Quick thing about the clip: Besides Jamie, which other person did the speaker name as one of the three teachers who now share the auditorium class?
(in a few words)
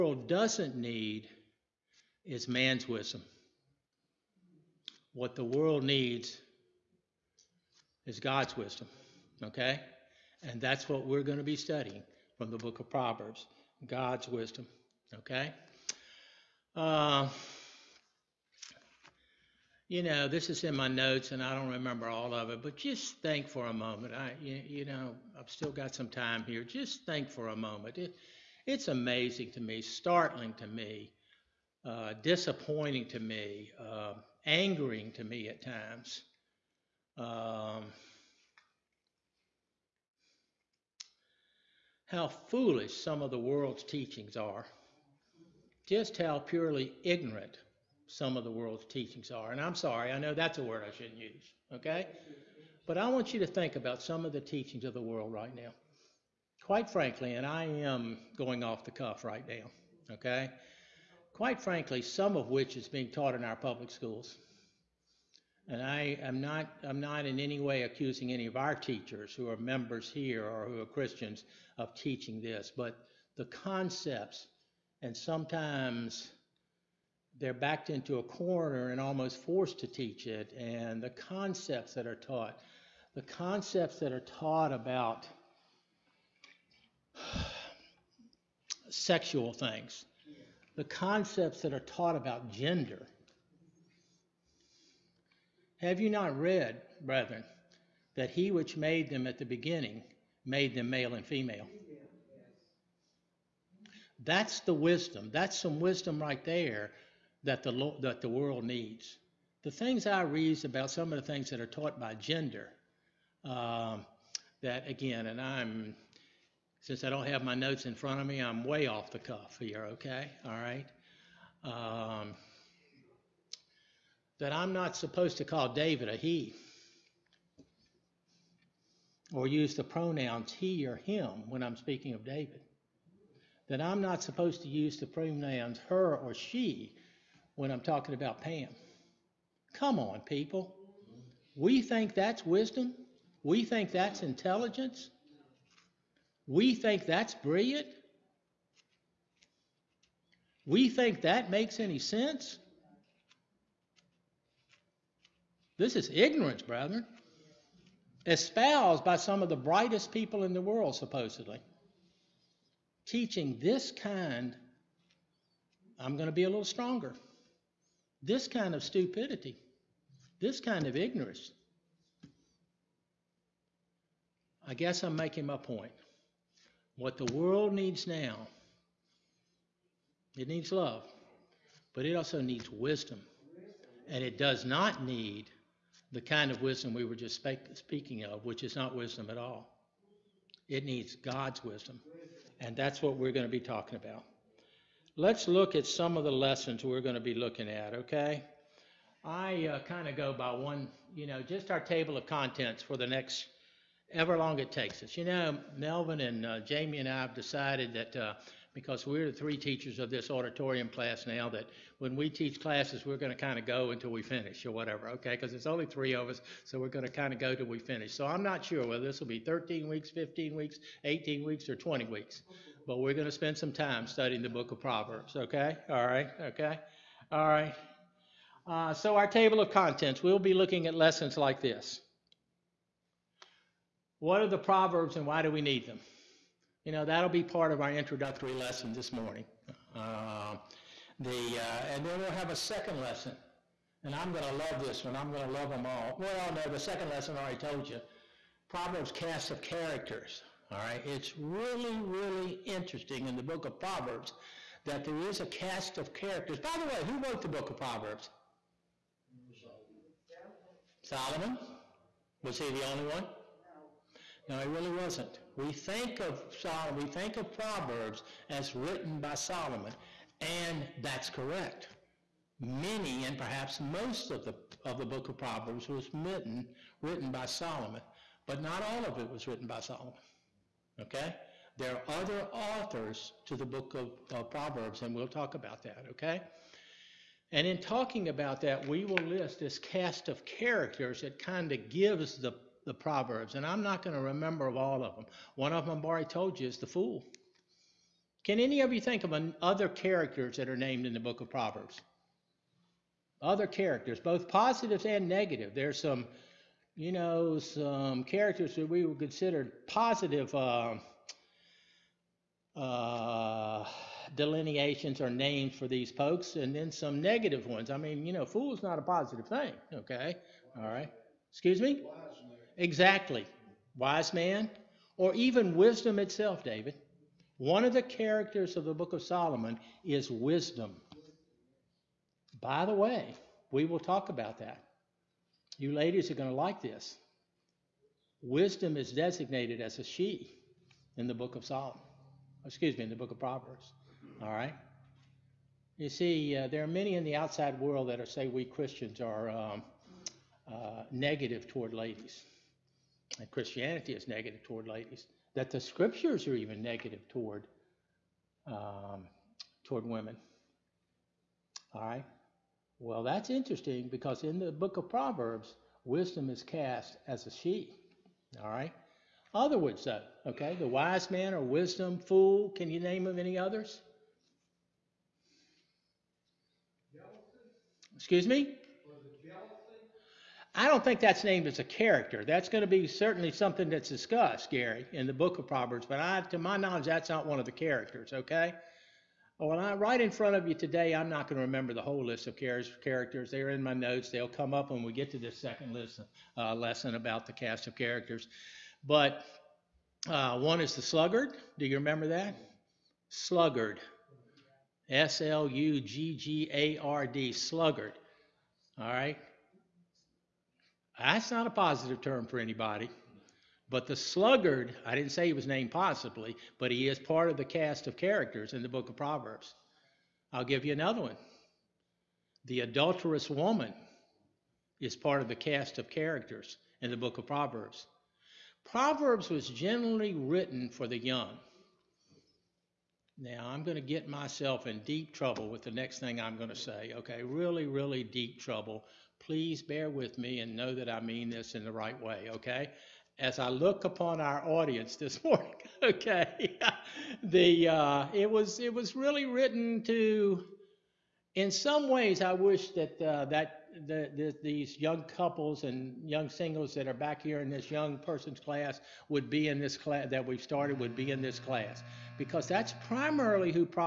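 Melvin.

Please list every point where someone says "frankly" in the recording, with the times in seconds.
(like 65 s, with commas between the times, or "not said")
56 s, 61 s.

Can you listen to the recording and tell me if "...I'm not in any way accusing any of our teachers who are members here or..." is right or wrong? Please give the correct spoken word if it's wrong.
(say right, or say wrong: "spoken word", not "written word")
right.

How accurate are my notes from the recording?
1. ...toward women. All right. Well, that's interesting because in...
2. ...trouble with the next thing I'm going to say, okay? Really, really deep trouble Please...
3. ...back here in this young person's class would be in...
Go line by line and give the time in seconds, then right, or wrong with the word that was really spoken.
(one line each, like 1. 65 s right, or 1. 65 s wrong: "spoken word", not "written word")
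1. 359 s right
2. 435 s right
3. 457 s right.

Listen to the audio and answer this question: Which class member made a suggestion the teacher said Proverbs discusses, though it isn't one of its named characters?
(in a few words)
Gary.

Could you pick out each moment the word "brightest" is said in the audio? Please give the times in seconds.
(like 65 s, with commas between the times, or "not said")
159 s.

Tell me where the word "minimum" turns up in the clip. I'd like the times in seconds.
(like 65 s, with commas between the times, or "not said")
not said.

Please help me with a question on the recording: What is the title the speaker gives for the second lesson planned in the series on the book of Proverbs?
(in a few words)
Proverbs cast of characters.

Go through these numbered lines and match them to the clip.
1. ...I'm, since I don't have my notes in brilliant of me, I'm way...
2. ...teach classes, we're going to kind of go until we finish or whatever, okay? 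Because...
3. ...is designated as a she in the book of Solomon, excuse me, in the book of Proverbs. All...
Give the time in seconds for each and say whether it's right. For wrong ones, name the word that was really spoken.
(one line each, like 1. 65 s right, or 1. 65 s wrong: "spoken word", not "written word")
1. 115 s wrong: "front", not "brilliant"
2. 212 s right
3. 338 s right.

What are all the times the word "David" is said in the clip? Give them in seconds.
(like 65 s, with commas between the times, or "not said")
125 s, 132 s, 326 s.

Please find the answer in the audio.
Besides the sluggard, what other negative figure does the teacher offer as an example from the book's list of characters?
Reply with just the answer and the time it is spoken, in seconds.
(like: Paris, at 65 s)
The adulterous woman, at 422 s.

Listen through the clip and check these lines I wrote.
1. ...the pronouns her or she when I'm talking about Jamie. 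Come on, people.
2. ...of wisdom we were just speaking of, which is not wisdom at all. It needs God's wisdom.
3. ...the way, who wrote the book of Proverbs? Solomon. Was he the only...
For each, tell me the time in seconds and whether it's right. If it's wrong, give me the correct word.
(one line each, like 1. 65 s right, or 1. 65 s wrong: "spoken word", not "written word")
1. 134 s wrong: "Pam", not "Jamie"
2. 186 s right
3. 256 s right.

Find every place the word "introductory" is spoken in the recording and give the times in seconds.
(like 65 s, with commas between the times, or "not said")
237 s.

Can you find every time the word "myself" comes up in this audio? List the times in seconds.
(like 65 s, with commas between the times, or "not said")
434 s.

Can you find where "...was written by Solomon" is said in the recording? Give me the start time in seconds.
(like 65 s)
279 s.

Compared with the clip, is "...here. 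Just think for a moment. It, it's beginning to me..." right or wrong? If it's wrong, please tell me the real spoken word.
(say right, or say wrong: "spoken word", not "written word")
wrong: "amazing", not "beginning".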